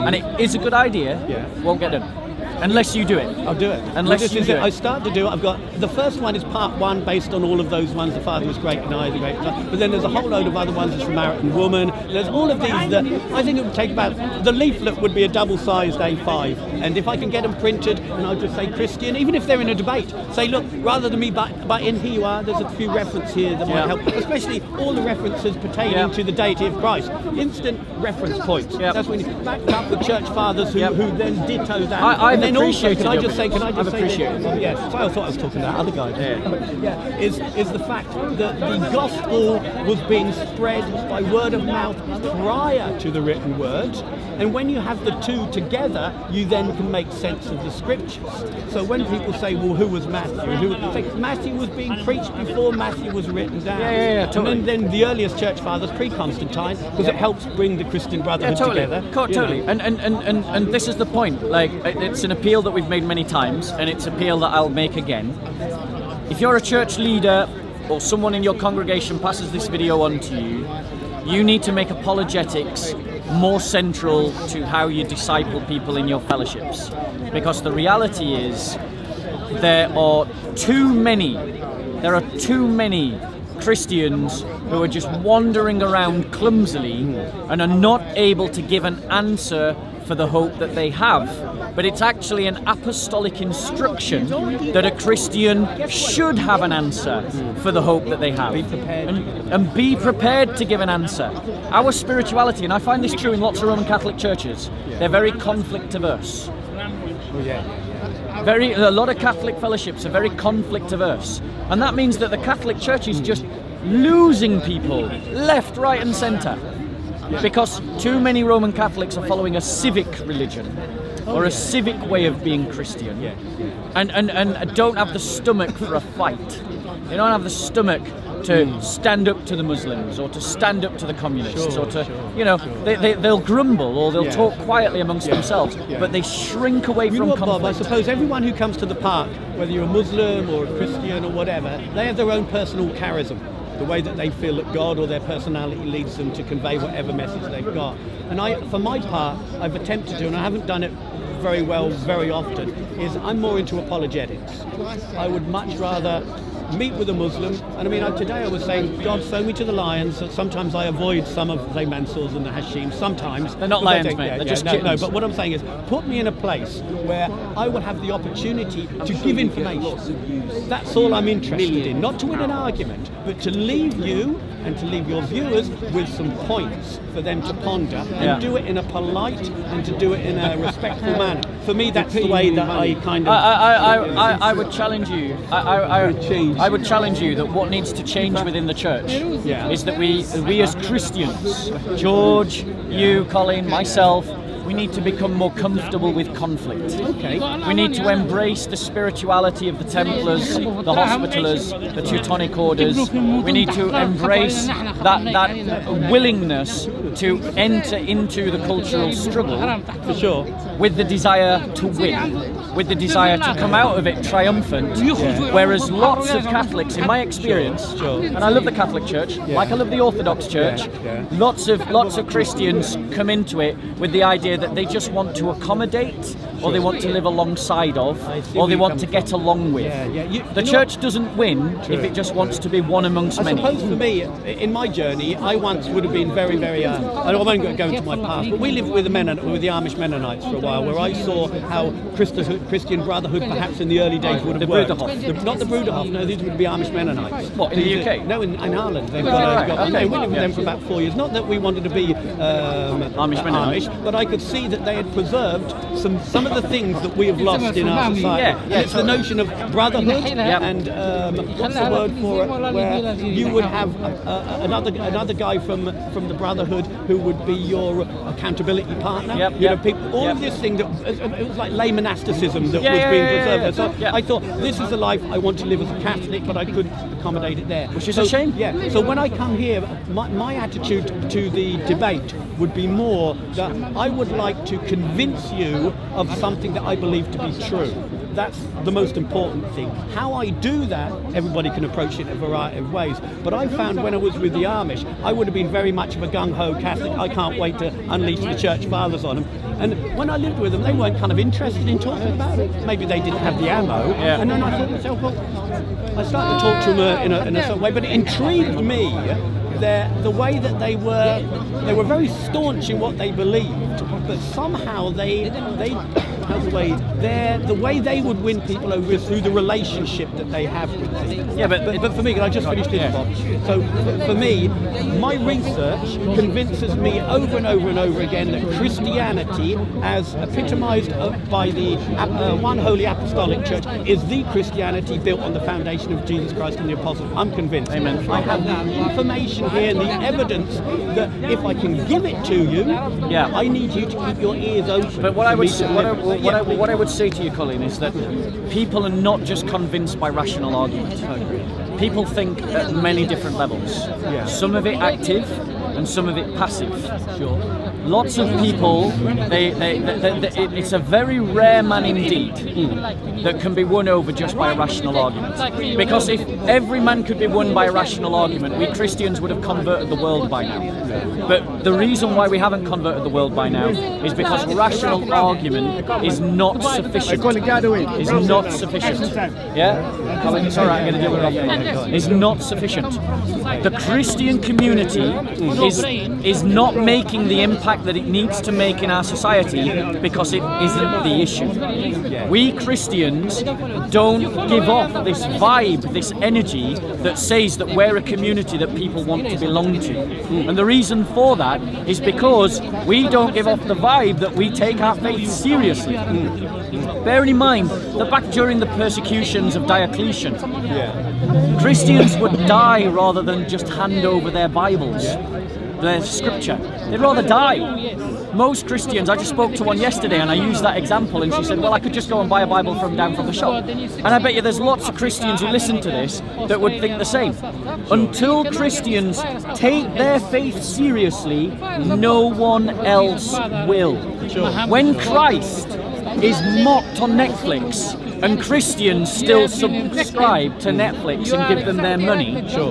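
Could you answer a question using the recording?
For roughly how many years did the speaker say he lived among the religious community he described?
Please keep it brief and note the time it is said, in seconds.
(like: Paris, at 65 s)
4, at 250 s.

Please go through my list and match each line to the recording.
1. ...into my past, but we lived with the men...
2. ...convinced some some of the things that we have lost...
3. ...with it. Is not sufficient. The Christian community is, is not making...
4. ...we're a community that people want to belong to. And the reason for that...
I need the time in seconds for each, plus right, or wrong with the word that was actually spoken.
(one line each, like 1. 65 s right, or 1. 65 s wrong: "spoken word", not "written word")
1. 237 s right
2. 255 s wrong: "preserved", not "convinced"
3. 381 s right
4. 397 s right.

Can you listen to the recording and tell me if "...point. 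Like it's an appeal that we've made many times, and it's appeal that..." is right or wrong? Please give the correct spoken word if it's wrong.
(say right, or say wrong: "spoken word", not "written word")
right.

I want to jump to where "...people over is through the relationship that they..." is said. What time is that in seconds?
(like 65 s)
318 s.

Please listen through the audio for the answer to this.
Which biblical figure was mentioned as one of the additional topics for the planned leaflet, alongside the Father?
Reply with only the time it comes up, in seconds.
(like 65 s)
10 s.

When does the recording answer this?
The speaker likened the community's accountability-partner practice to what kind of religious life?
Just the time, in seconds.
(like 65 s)
271 s.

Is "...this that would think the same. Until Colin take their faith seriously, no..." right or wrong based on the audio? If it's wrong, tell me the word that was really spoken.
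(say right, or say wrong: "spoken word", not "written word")
wrong: "Christians", not "Colin".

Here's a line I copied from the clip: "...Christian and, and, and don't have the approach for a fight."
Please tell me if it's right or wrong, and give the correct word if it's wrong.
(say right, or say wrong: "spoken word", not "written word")
wrong: "stomach", not "approach".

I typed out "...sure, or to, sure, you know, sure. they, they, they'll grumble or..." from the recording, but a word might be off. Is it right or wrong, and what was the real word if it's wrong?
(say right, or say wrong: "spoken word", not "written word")
right.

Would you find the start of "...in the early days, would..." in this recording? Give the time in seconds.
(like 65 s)
243 s.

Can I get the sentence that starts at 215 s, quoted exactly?
whereas lots of catholics in my experience sure, sure.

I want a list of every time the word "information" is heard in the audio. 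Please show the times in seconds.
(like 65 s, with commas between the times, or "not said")
169 s, 339 s.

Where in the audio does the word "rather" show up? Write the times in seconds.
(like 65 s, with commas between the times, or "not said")
20 s, 155 s, 413 s, 417 s.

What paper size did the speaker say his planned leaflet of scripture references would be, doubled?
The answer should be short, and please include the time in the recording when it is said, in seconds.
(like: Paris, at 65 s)
A5, at 15 s.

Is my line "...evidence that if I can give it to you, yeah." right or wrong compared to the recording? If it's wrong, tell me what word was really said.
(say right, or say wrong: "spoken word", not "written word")
right.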